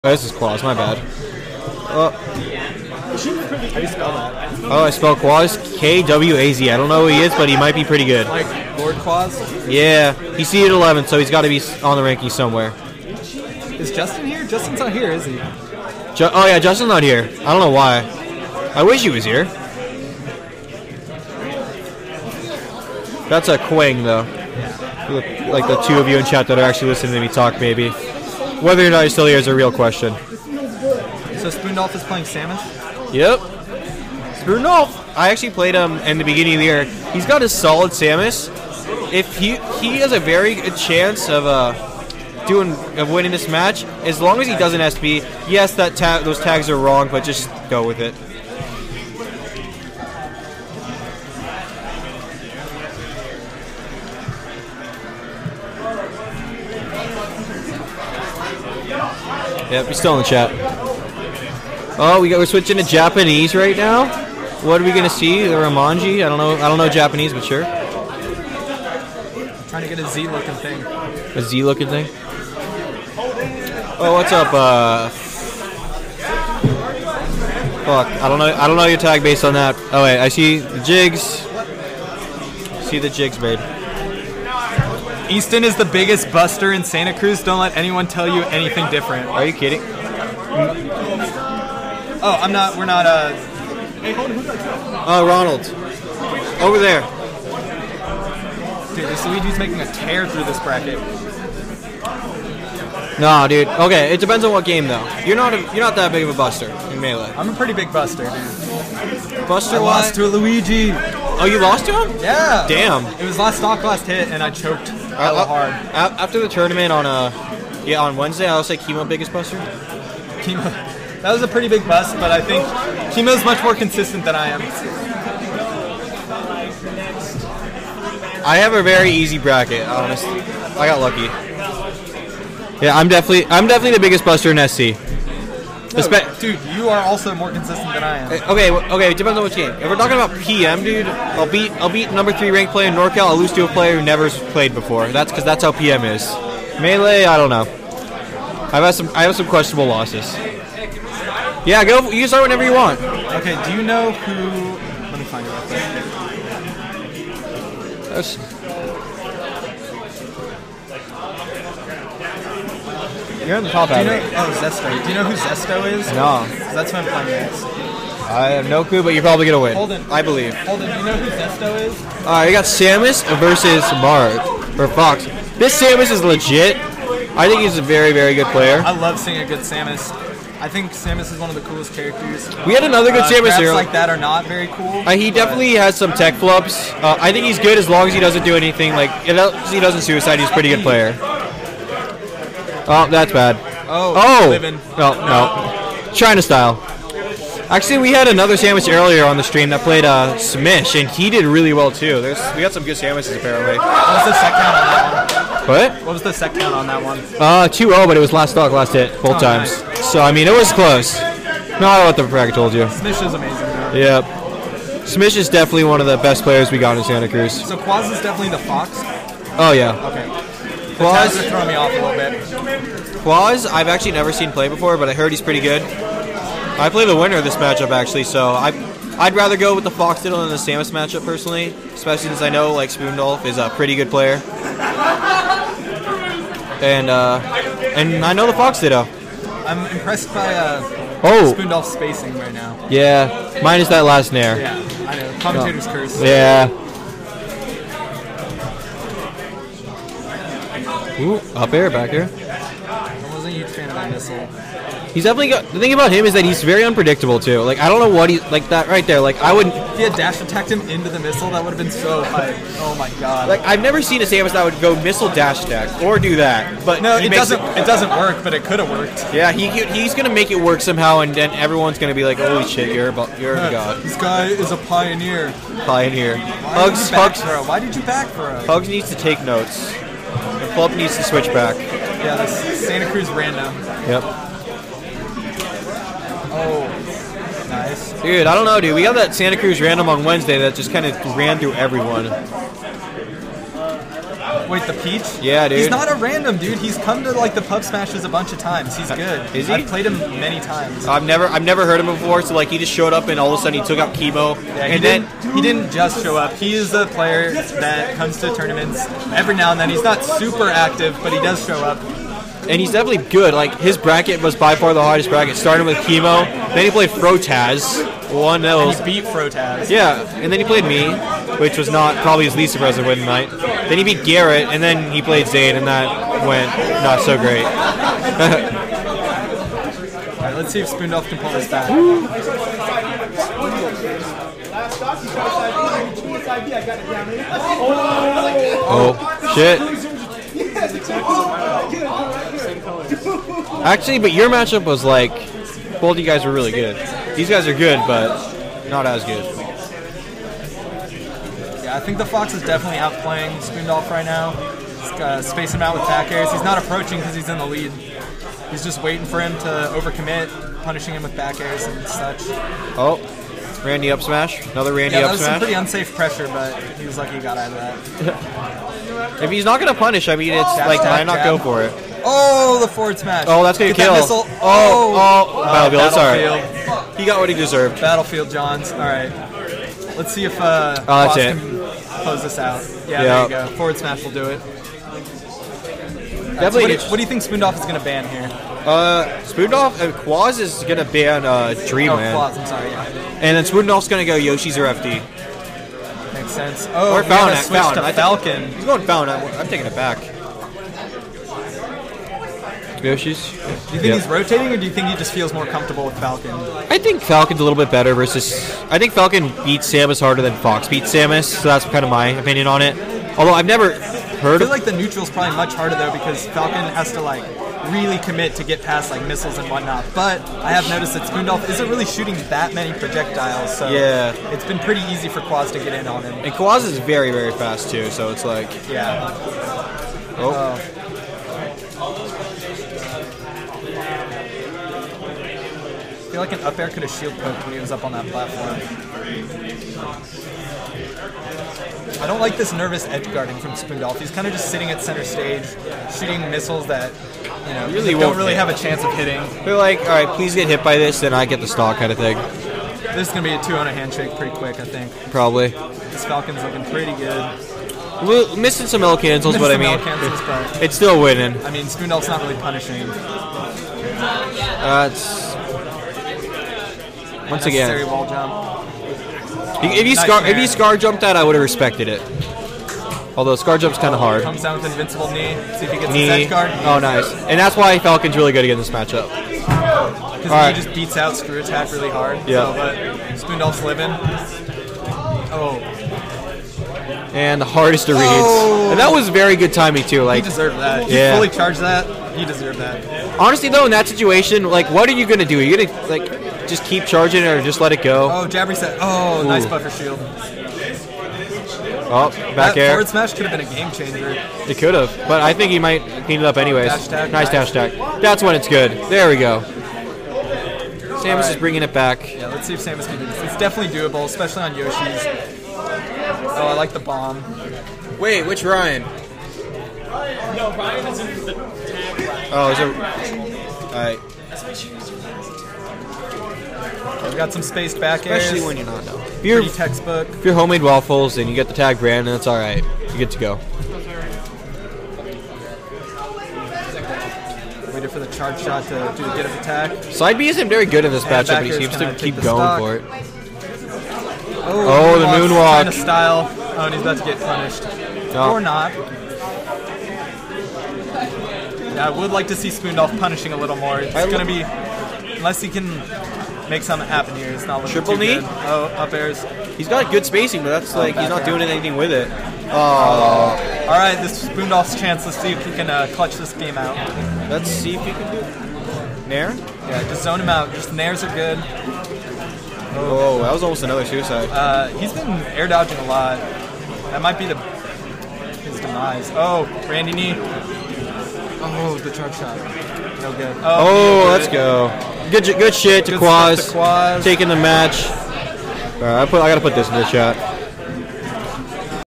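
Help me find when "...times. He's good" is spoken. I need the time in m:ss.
4:58.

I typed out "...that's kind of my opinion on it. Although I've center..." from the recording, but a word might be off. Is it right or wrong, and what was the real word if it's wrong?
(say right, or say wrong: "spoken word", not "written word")
wrong: "never", not "center".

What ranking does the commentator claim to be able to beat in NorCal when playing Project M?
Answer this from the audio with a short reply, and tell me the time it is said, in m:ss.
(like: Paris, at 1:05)
Number three, at 2:22.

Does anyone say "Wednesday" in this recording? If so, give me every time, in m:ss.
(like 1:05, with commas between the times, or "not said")
1:58, 4:50.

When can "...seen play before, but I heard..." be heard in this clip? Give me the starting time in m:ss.
3:44.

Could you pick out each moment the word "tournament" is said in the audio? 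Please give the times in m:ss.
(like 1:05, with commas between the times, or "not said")
1:56, 5:08.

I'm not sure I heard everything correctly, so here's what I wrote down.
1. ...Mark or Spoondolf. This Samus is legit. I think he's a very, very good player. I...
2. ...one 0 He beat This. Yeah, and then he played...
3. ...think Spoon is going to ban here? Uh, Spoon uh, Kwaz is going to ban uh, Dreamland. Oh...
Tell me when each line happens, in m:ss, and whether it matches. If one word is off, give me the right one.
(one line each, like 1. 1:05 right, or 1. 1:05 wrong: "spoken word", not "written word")
1. 2:54 wrong: "Fox", not "Spoondolf"
2. 5:18 wrong: "Frotaz", not "This"
3. 6:27 right.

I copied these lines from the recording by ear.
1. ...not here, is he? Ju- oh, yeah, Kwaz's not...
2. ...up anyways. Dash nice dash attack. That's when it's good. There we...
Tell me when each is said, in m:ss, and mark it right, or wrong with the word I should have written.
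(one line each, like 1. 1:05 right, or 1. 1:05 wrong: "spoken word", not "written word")
1. 0:14 wrong: "Justin", not "Kwaz"
2. 8:26 right.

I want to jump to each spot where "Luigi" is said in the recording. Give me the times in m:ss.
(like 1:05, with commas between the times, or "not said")
1:39, 1:50.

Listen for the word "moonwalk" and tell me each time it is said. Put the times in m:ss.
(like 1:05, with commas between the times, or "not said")
9:05.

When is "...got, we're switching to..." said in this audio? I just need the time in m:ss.
1:02.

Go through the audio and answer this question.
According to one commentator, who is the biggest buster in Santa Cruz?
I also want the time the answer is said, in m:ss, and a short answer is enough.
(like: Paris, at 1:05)
Easton, at 1:25.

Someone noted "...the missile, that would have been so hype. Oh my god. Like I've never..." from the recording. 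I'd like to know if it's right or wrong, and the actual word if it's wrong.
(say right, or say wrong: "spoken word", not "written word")
right.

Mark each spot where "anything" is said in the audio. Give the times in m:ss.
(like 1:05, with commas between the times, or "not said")
1:28, 3:08, 9:21.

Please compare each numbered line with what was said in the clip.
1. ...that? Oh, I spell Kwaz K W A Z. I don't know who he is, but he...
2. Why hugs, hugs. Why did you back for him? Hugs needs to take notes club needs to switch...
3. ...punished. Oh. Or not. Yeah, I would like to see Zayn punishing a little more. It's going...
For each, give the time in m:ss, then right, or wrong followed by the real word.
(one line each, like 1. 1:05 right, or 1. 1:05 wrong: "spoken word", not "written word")
1. 0:04 right
2. 4:36 right
3. 9:07 wrong: "Spoondolf", not "Zayn".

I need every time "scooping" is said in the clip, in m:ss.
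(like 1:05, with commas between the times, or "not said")
not said.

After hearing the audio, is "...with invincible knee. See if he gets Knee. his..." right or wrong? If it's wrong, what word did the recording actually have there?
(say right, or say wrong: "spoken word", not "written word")
right.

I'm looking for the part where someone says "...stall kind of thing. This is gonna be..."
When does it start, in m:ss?
7:31.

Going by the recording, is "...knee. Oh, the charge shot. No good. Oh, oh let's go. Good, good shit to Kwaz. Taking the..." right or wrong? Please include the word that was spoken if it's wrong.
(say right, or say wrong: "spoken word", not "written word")
right.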